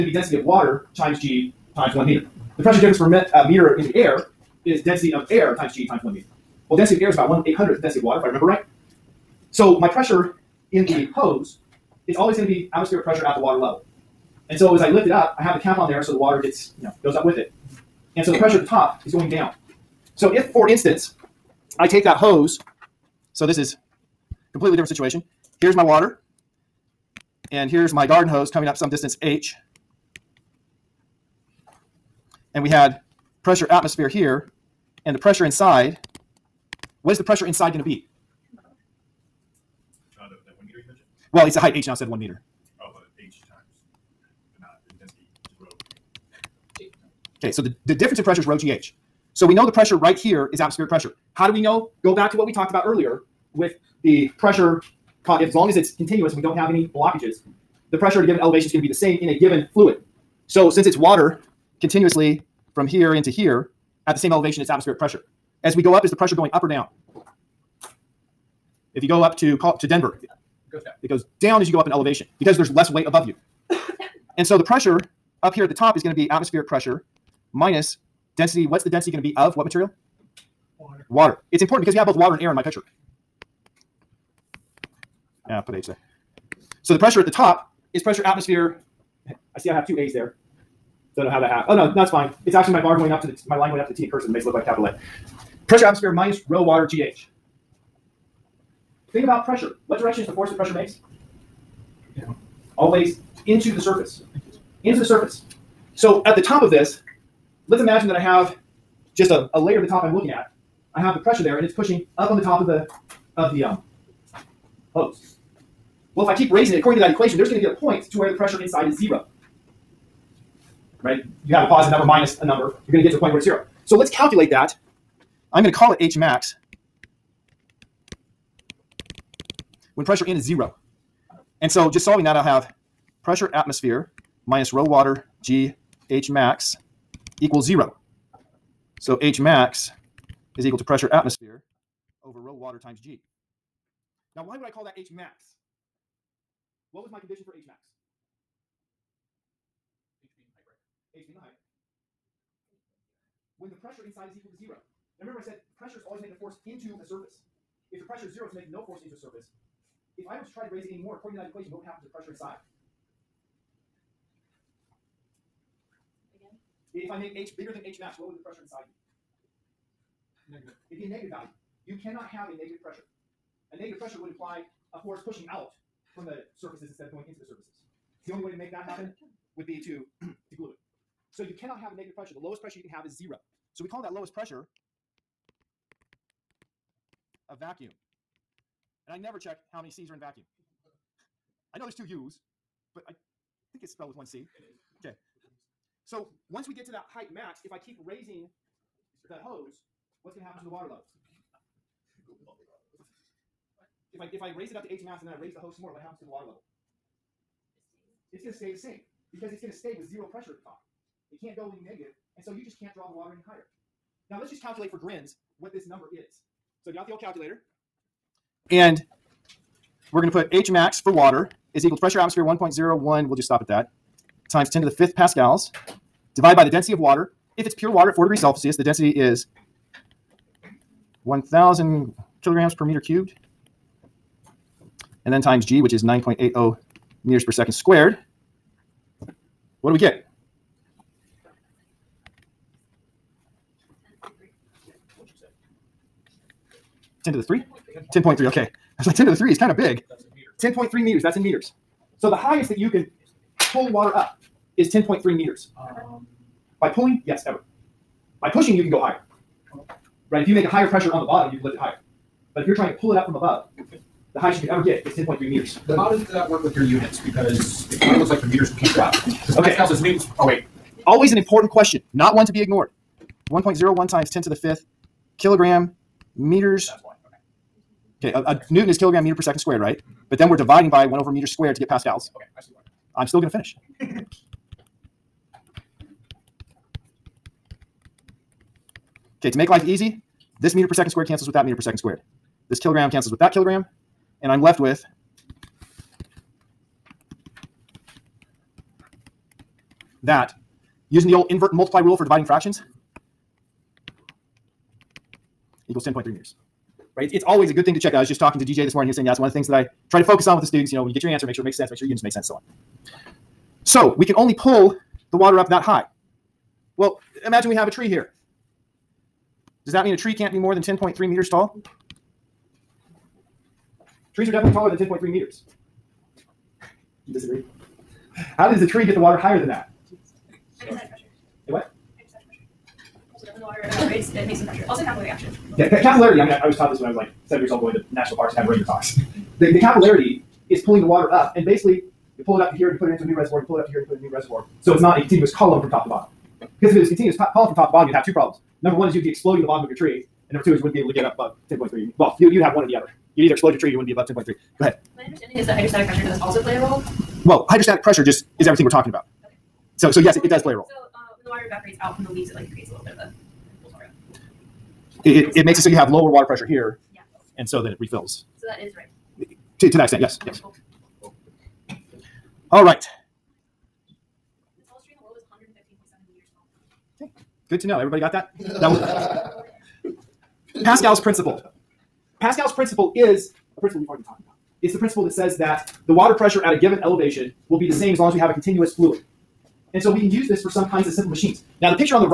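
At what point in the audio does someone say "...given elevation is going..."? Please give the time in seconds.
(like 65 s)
58 s.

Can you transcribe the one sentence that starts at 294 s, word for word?
And I'm left with that using the old invert and multiply rule for dividing fractions.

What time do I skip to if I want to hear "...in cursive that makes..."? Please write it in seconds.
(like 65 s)
94 s.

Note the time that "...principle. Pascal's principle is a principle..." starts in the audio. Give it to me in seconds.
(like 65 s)
381 s.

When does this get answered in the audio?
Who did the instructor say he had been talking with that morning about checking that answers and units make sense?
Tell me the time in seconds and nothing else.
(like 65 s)
308 s.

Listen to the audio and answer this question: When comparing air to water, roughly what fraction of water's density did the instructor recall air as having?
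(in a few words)
1/800.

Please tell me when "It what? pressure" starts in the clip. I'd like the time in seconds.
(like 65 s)
331 s.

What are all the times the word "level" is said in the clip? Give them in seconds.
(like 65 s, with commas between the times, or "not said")
13 s, 200 s, 206 s.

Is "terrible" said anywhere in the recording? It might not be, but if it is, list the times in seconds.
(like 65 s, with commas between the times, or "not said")
not said.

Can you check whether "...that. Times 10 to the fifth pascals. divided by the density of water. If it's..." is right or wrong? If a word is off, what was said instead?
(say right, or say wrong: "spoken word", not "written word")
right.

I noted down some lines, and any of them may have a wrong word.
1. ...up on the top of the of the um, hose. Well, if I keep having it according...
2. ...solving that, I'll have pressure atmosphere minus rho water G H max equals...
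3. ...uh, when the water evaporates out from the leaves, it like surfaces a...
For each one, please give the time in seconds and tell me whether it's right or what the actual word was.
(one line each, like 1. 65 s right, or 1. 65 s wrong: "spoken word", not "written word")
1. 112 s wrong: "raising", not "having"
2. 132 s right
3. 361 s wrong: "creates", not "surfaces".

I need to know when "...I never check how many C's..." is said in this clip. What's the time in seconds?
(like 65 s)
189 s.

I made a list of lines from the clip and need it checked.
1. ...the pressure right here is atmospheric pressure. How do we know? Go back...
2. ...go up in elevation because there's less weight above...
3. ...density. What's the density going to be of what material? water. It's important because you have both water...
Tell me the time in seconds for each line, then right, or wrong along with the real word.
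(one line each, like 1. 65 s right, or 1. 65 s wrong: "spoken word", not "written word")
1. 49 s right
2. 71 s right
3. 78 s right.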